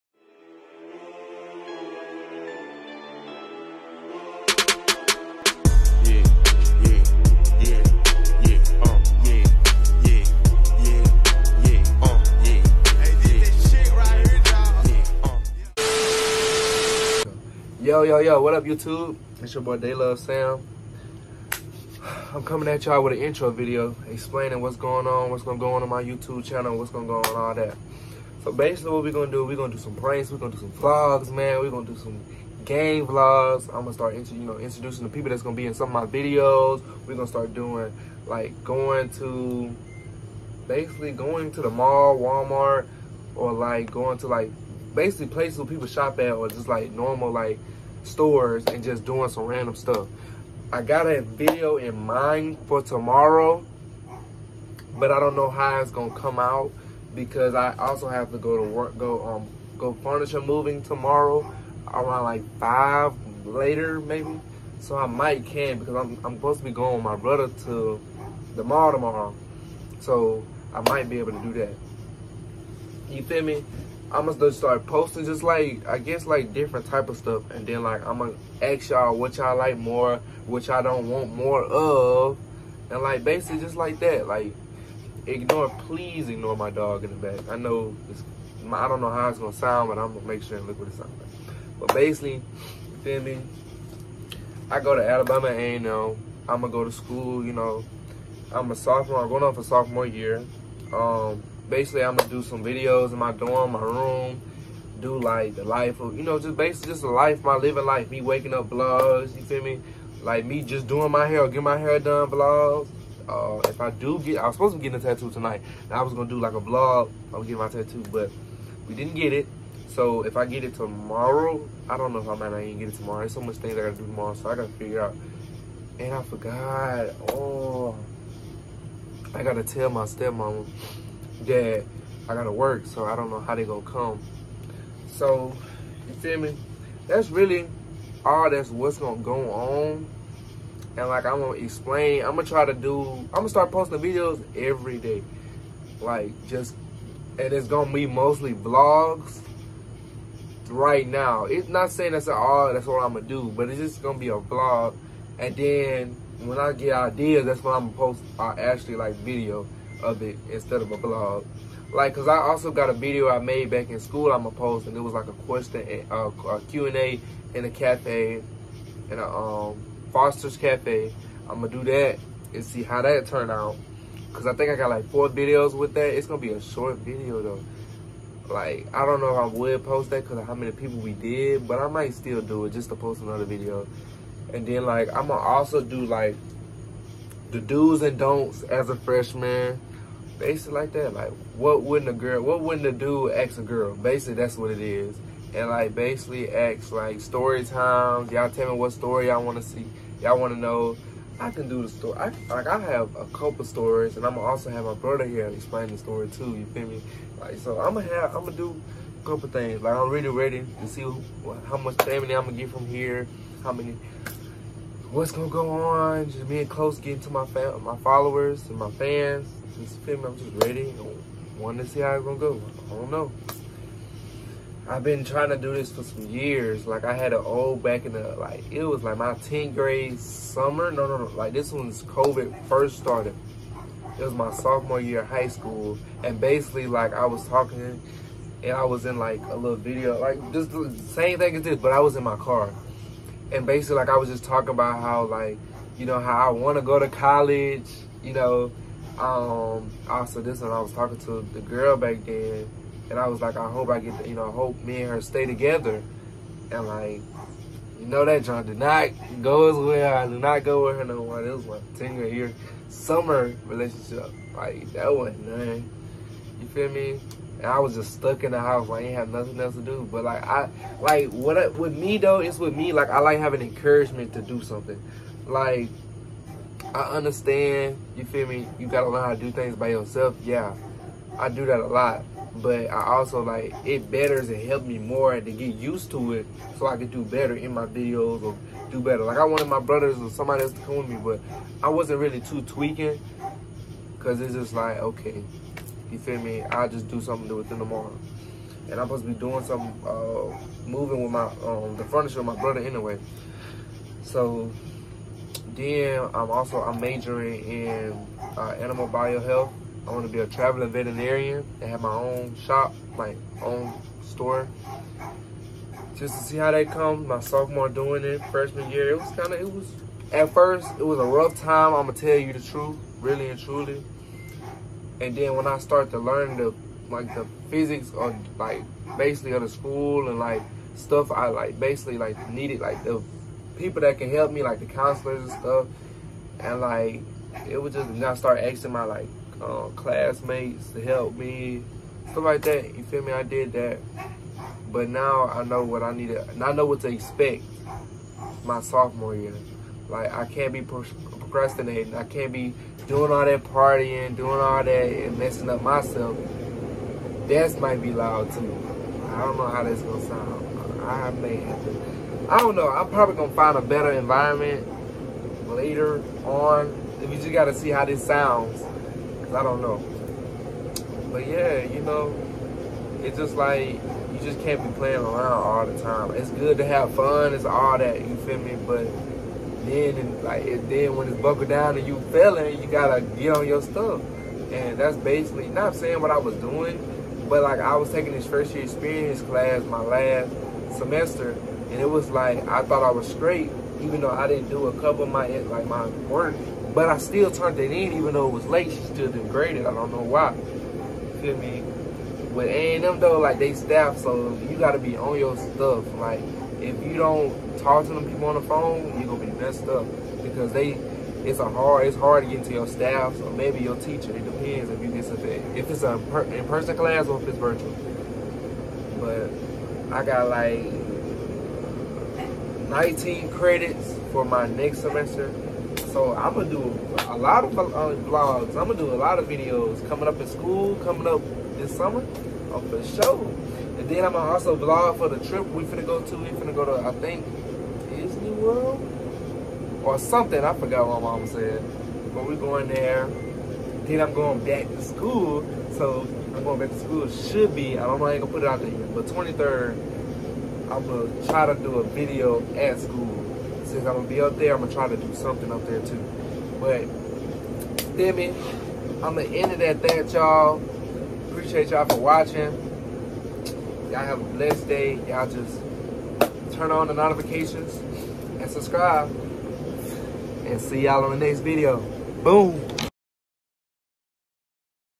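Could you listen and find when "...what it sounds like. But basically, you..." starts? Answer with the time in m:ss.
1:30.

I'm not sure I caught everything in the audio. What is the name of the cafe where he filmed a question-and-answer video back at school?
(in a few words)
Foster's Cafe.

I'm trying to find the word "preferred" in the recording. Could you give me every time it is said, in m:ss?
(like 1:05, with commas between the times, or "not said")
not said.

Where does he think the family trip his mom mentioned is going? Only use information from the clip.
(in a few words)
Disney World.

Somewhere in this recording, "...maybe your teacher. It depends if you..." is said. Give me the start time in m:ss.
6:53.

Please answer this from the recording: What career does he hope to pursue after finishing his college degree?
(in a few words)
Traveling veterinarian.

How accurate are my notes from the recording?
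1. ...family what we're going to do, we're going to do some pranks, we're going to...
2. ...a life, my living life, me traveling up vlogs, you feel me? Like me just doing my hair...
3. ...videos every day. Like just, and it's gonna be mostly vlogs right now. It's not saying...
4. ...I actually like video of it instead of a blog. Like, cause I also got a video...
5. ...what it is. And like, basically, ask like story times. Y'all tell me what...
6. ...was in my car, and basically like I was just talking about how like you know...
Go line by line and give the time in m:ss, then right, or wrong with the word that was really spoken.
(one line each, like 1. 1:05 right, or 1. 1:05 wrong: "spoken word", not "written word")
1. 0:28 wrong: "basically", not "family"
2. 1:47 wrong: "waking", not "traveling"
3. 2:23 right
4. 2:38 right
5. 3:14 right
6. 4:01 right.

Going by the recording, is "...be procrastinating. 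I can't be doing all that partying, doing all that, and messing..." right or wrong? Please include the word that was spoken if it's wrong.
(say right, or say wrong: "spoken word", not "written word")
right.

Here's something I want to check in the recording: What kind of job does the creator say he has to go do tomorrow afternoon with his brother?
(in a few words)
Furniture moving.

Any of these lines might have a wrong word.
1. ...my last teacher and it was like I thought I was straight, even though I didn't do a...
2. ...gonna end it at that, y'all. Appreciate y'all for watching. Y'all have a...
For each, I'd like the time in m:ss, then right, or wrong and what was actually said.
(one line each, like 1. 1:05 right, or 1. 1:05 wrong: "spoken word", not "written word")
1. 6:29 wrong: "semester", not "teacher"
2. 7:39 right.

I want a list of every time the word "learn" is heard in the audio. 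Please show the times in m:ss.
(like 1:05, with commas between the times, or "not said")
4:39, 5:26.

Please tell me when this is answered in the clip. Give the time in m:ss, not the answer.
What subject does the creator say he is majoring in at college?
5:08.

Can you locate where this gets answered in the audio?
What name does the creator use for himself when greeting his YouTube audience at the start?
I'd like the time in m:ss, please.
0:19.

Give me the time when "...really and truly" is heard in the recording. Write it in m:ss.
5:23.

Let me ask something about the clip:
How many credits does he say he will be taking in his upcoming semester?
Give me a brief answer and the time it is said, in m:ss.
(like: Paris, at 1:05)
19, at 7:02.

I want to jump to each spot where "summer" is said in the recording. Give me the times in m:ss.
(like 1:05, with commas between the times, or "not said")
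3:50, 4:22, 7:11.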